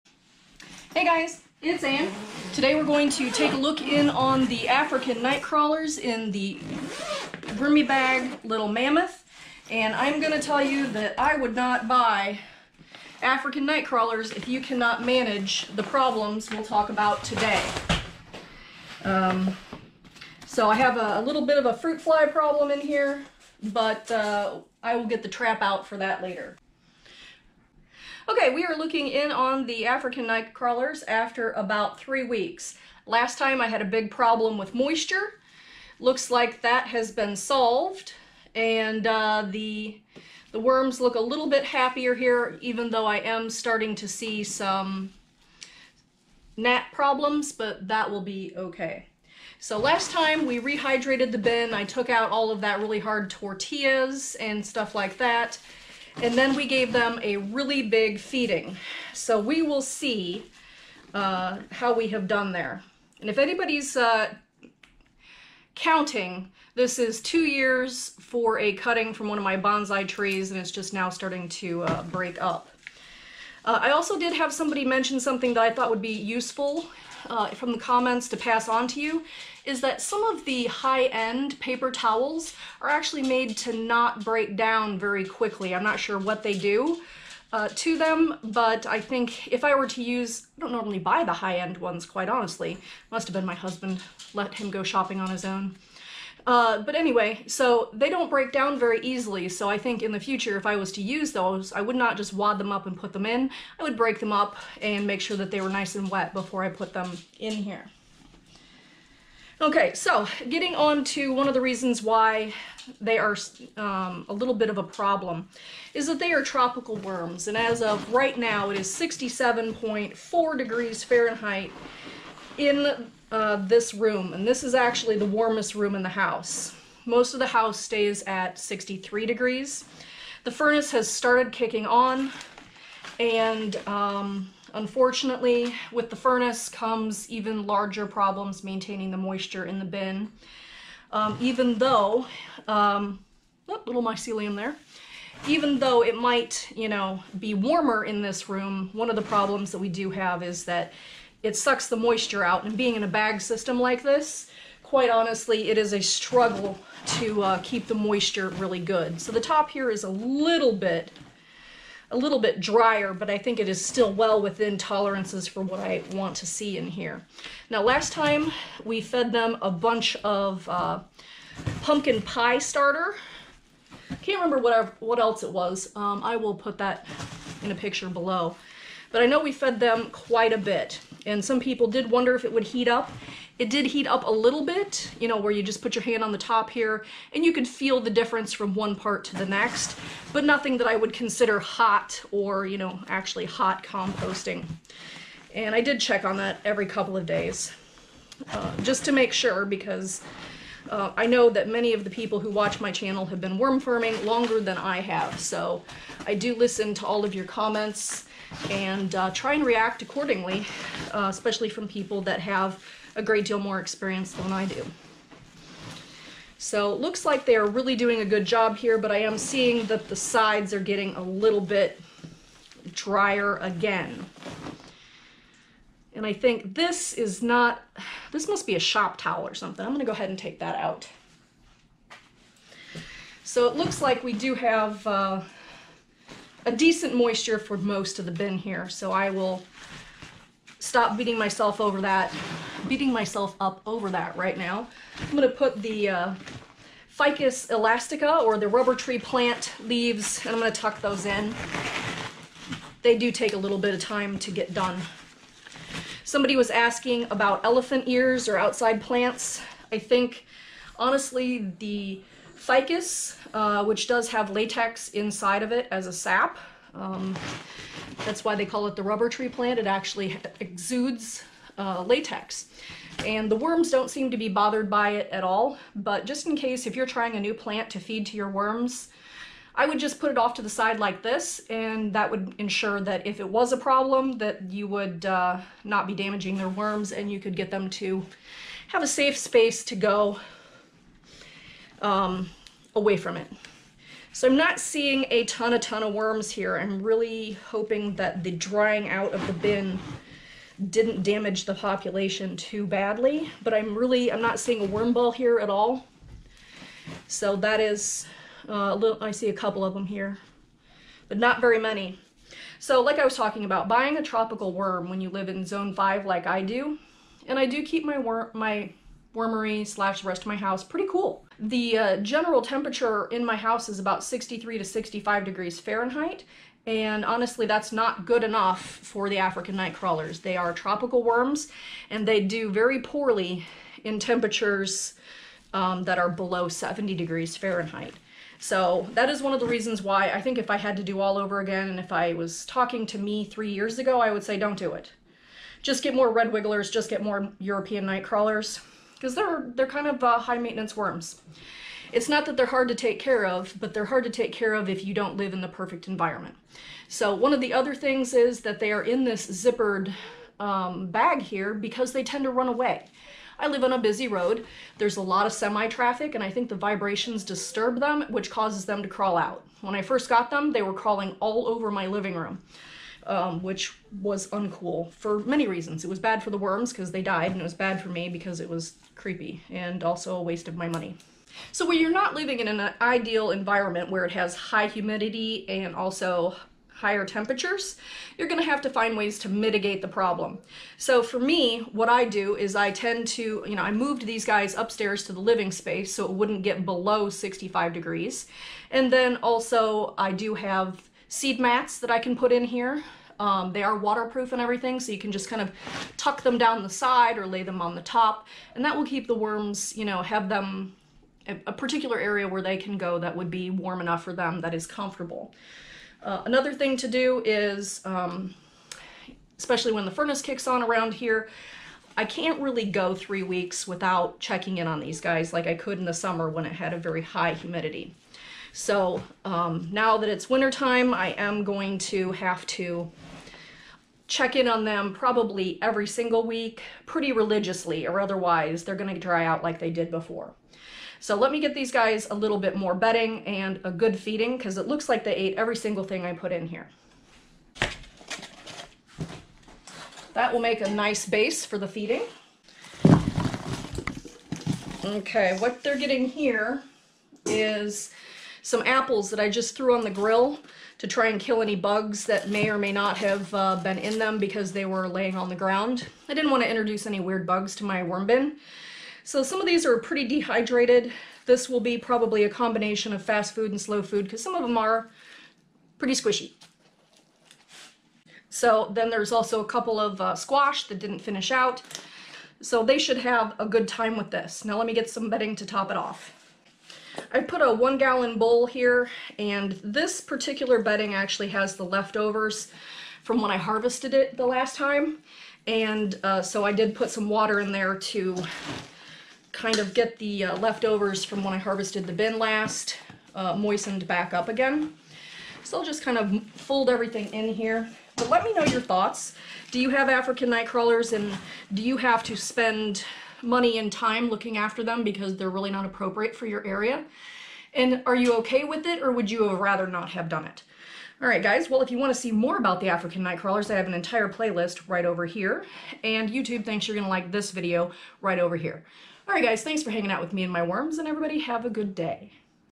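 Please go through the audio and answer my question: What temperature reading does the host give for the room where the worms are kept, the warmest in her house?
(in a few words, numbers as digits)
67.4°F.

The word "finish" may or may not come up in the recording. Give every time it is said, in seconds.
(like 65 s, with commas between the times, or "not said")
481 s.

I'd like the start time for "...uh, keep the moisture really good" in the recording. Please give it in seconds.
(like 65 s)
157 s.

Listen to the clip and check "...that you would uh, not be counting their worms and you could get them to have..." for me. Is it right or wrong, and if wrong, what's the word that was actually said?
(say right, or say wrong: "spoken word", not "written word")
wrong: "damaging", not "counting".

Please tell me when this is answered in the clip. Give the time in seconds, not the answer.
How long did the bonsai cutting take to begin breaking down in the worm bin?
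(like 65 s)
67 s.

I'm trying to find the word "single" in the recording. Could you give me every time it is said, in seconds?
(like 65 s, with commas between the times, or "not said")
436 s, 445 s.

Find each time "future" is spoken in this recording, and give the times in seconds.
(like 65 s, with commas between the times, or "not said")
100 s.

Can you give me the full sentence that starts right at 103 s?
I would break them up and make sure that they were nice and wet before I put them in here.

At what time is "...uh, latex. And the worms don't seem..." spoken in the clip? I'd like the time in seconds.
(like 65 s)
271 s.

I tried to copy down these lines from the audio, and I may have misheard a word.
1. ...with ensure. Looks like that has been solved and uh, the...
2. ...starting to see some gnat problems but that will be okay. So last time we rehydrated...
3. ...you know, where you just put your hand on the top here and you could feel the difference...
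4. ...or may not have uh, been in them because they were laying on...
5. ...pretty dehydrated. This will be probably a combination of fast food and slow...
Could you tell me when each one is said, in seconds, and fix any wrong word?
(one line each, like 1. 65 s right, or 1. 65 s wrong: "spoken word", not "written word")
1. 34 s wrong: "moisture", not "ensure"
2. 43 s right
3. 185 s right
4. 462 s right
5. 469 s right.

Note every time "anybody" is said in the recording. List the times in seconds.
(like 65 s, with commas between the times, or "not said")
63 s.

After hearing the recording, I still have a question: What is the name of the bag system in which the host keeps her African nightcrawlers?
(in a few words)
Vermi Bag Little Mammoth.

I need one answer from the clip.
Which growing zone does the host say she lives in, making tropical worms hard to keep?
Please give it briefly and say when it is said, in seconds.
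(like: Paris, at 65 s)
zone 5, at 315 s.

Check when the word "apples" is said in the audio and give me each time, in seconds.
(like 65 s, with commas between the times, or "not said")
458 s.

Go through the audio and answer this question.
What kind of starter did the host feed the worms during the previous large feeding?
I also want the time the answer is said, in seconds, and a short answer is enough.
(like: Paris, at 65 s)
pumpkin pie starter, at 171 s.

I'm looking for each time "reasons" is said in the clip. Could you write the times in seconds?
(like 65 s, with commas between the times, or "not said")
111 s, 339 s, 375 s.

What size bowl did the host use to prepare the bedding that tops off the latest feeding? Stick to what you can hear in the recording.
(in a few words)
1 gallon.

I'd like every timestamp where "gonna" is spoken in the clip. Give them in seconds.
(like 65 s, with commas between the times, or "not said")
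229 s, 245 s, 250 s, 438 s.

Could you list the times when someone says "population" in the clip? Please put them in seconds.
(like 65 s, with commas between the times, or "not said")
301 s.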